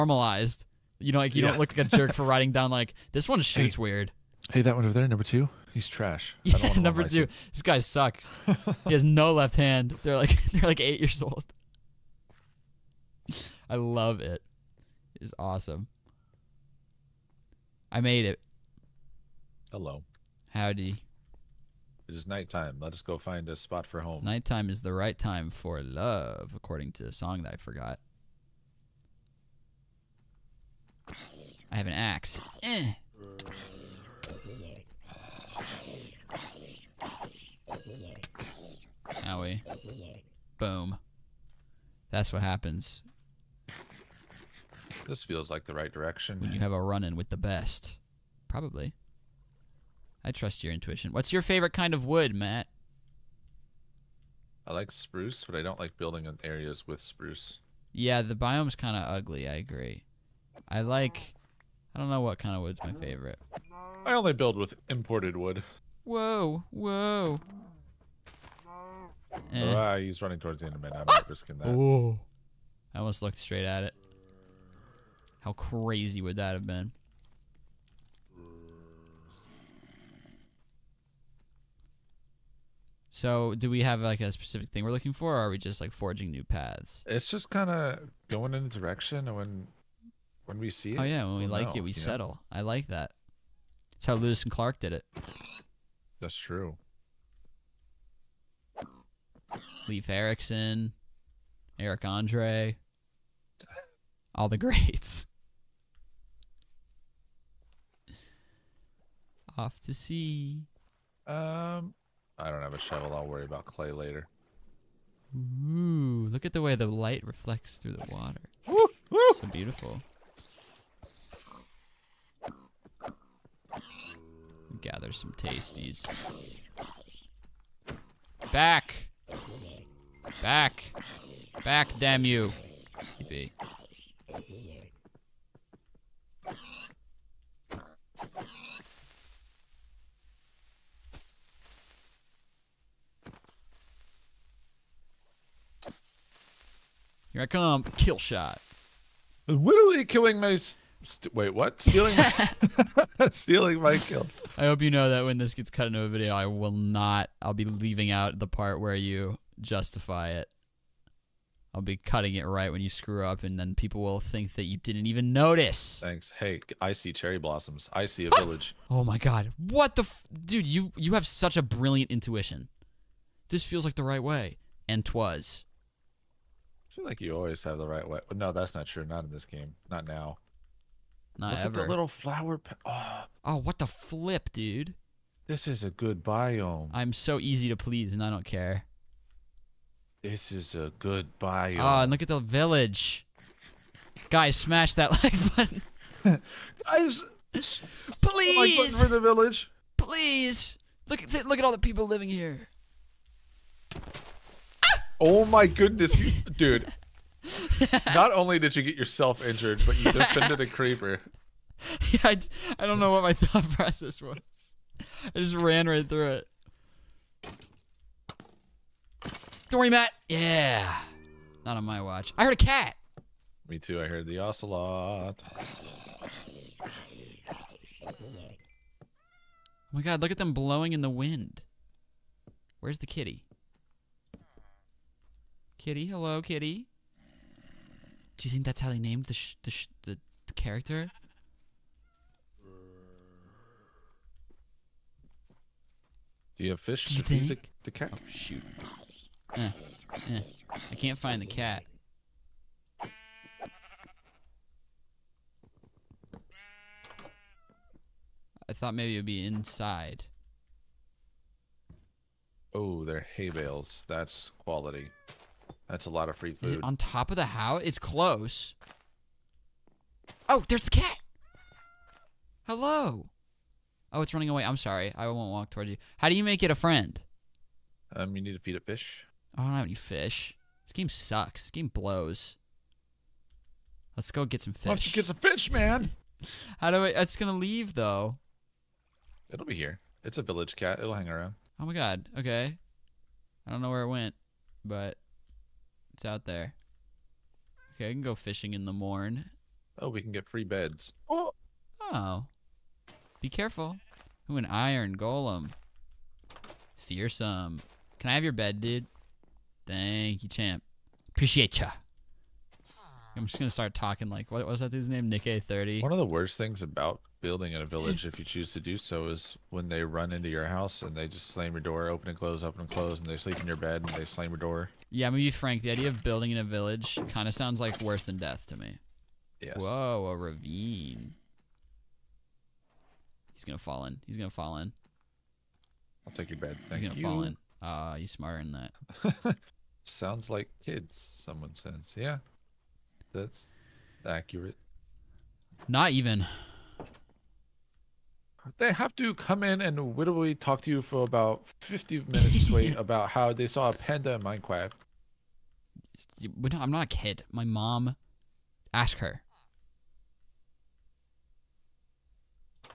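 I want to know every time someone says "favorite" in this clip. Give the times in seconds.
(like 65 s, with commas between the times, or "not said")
51 s, 62 s.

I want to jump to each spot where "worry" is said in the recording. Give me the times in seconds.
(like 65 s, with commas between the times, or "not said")
113 s, 219 s.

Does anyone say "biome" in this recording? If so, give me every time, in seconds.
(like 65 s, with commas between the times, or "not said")
58 s, 186 s, 191 s.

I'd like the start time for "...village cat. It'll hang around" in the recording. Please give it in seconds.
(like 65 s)
290 s.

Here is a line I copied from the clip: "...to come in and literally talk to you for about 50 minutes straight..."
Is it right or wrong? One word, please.
right.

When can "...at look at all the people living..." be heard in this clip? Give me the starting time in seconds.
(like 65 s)
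201 s.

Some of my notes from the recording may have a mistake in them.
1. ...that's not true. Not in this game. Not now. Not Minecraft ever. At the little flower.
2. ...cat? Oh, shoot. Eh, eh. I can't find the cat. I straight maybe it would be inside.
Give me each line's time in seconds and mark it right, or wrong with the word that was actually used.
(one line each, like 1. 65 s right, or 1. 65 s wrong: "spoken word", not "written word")
1. 178 s wrong: "Look", not "Minecraft"
2. 247 s wrong: "thought", not "straight".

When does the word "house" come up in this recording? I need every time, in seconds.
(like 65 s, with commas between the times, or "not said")
267 s, 320 s.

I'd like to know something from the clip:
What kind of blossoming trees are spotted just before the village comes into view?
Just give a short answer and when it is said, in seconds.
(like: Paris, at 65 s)
Cherry blossoms, at 167 s.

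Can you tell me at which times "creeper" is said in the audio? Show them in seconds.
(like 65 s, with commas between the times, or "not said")
210 s.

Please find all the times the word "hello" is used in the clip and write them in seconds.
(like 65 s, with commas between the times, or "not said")
19 s, 236 s, 272 s.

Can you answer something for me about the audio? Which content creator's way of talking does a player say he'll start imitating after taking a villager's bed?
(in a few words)
NickEh30.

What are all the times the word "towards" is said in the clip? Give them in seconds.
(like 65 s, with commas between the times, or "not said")
70 s, 275 s.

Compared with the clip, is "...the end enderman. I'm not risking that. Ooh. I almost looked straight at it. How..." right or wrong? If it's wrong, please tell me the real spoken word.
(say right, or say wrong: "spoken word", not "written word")
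right.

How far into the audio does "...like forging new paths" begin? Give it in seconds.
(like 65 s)
85 s.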